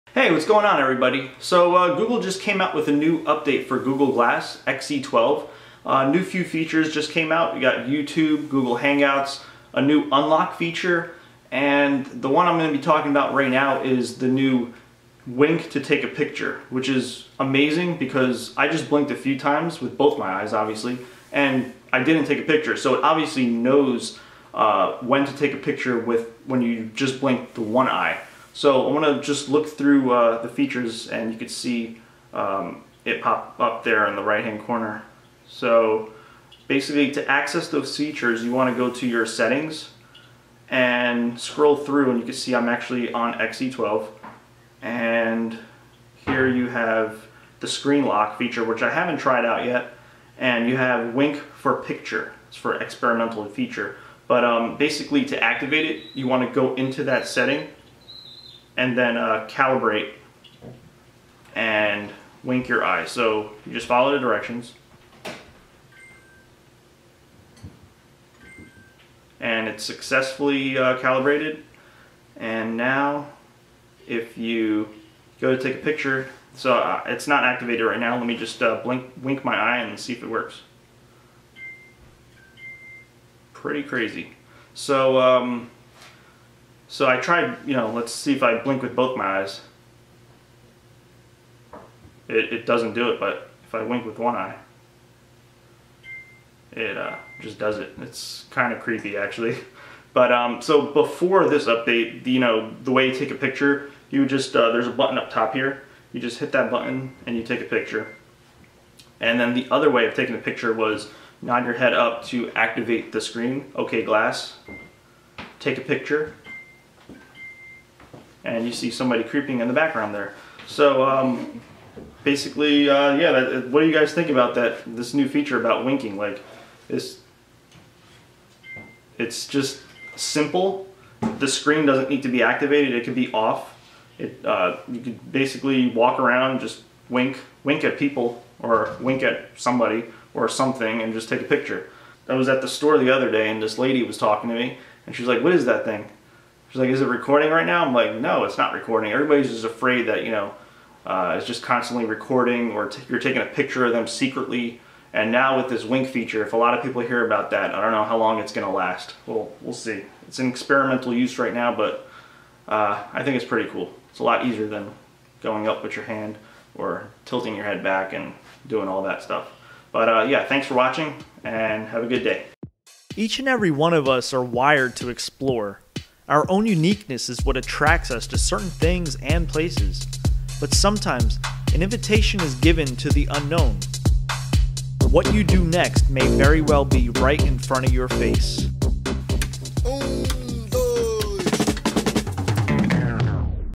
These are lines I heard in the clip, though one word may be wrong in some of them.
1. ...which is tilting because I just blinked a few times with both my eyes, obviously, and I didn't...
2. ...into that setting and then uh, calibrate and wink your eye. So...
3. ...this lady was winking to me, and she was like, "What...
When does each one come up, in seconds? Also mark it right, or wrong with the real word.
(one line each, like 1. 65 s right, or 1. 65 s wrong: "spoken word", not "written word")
1. 16 s wrong: "amazing", not "tilting"
2. 56 s right
3. 143 s wrong: "talking", not "winking".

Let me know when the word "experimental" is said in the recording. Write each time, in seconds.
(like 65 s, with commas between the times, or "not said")
52 s, 160 s.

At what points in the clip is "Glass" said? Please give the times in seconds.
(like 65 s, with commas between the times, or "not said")
4 s, 114 s.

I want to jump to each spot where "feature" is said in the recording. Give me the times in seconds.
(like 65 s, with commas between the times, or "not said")
6 s, 10 s, 30 s, 37 s, 48 s, 53 s, 125 s, 156 s.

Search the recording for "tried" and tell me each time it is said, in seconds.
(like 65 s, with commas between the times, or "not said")
49 s, 87 s.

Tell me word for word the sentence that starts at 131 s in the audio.
The screen doesn't need to be activated; it could be off.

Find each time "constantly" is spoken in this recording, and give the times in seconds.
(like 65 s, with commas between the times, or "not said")
151 s.